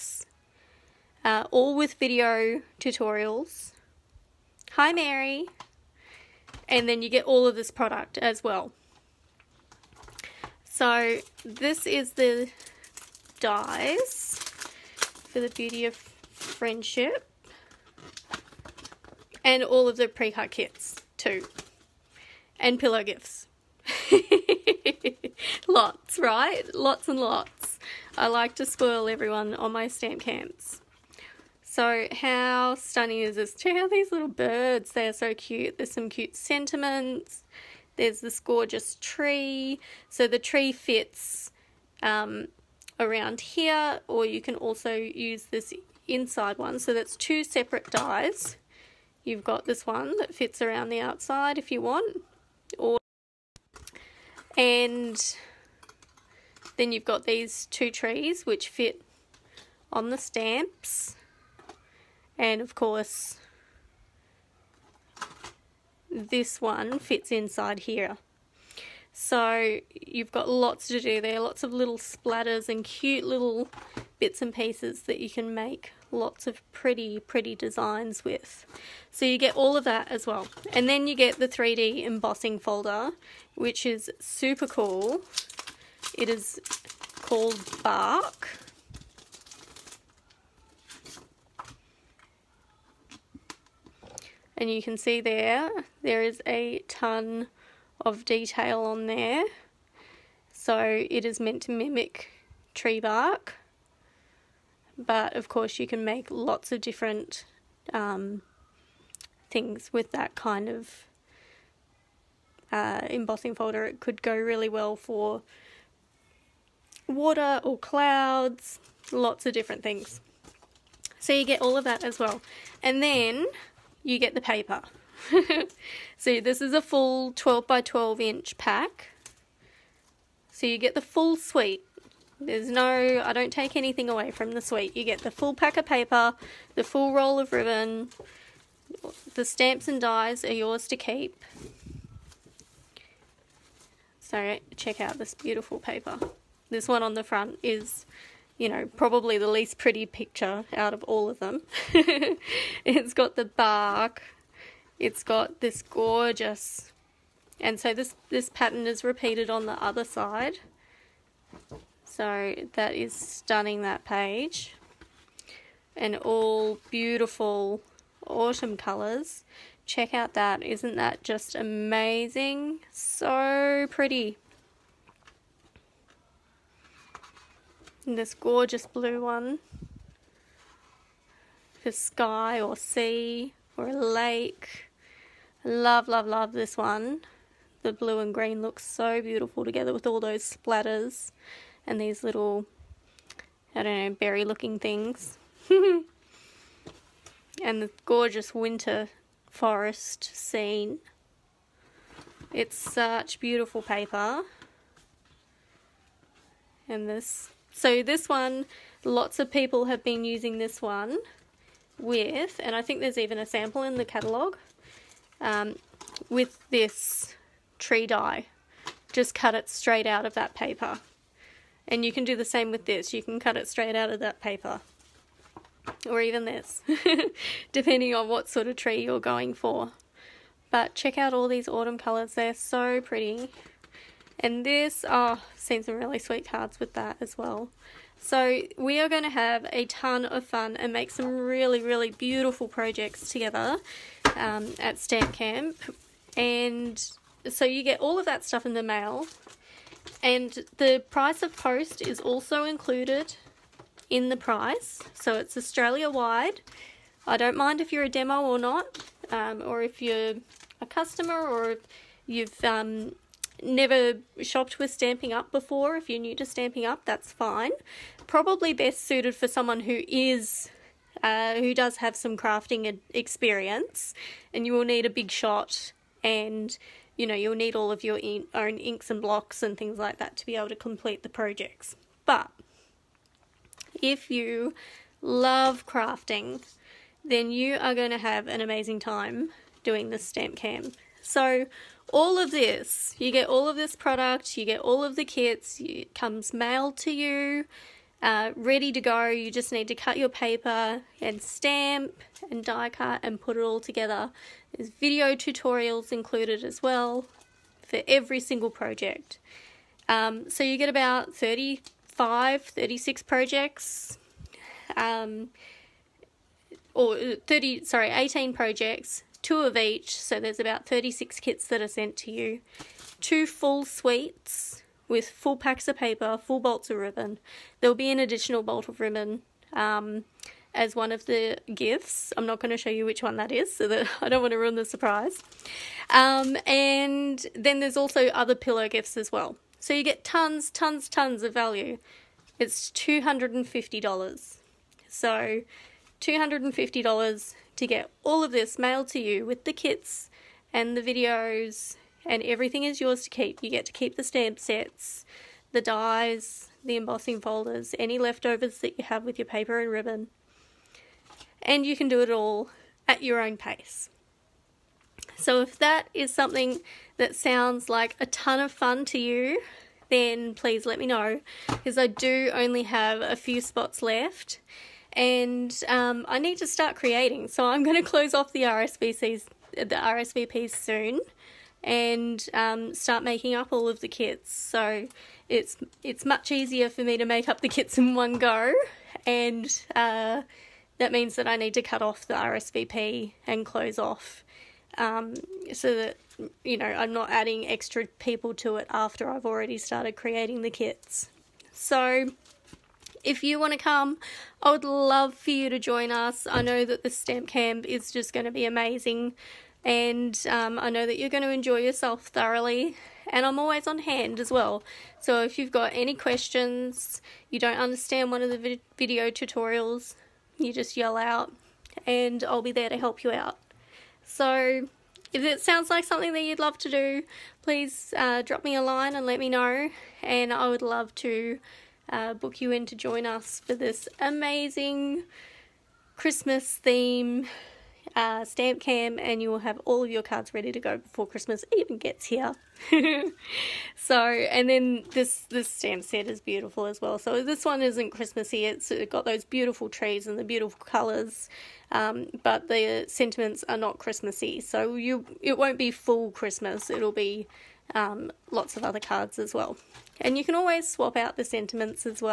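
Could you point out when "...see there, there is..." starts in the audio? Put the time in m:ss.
1:34.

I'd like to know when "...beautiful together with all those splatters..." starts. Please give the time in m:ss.
3:09.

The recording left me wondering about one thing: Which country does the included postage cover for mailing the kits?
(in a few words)
Australia.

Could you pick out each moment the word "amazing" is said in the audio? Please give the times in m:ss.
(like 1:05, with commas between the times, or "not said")
2:51, 4:48, 6:48, 7:14.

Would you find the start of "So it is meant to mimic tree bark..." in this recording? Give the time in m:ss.
1:40.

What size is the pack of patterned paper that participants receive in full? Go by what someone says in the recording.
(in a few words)
12 by 12 inch.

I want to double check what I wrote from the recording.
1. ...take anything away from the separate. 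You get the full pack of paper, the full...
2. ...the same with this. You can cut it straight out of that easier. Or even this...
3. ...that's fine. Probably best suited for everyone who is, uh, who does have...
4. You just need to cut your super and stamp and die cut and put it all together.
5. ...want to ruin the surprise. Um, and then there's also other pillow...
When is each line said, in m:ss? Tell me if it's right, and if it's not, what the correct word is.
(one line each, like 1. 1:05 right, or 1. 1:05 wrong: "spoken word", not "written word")
1. 2:13 wrong: "suite", not "separate"
2. 3:42 wrong: "paper", not "easier"
3. 4:27 wrong: "someone", not "everyone"
4. 4:59 wrong: "paper", not "super"
5. 5:34 right.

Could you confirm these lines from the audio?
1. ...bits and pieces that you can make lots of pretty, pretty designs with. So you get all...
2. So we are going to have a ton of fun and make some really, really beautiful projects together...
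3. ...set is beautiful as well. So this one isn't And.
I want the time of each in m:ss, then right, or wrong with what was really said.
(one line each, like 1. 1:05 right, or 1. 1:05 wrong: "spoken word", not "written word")
1. 1:14 right
2. 3:58 right
3. 7:26 wrong: "Christmassy", not "And".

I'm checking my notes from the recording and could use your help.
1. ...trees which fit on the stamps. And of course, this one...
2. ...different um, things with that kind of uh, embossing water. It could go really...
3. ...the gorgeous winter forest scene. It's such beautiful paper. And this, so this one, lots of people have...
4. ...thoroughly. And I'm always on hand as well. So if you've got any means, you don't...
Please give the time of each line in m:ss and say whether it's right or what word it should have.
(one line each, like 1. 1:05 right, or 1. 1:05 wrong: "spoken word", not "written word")
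1. 0:57 right
2. 1:46 wrong: "folder", not "water"
3. 3:17 right
4. 6:52 wrong: "questions", not "means".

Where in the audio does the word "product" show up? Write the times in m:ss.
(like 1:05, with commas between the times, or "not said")
0:07, 4:53.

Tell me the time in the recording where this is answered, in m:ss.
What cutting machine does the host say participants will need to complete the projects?
4:35.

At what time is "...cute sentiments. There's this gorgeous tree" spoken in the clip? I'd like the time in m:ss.
0:36.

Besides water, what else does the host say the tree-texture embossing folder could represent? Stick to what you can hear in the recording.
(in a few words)
Clouds.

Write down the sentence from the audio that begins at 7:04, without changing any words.
So if it sounds like something that you'd love to do, please uh, drop me a line and let me know.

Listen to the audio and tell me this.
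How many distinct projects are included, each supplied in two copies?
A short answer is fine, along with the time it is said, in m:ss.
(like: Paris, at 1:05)
18, at 5:18.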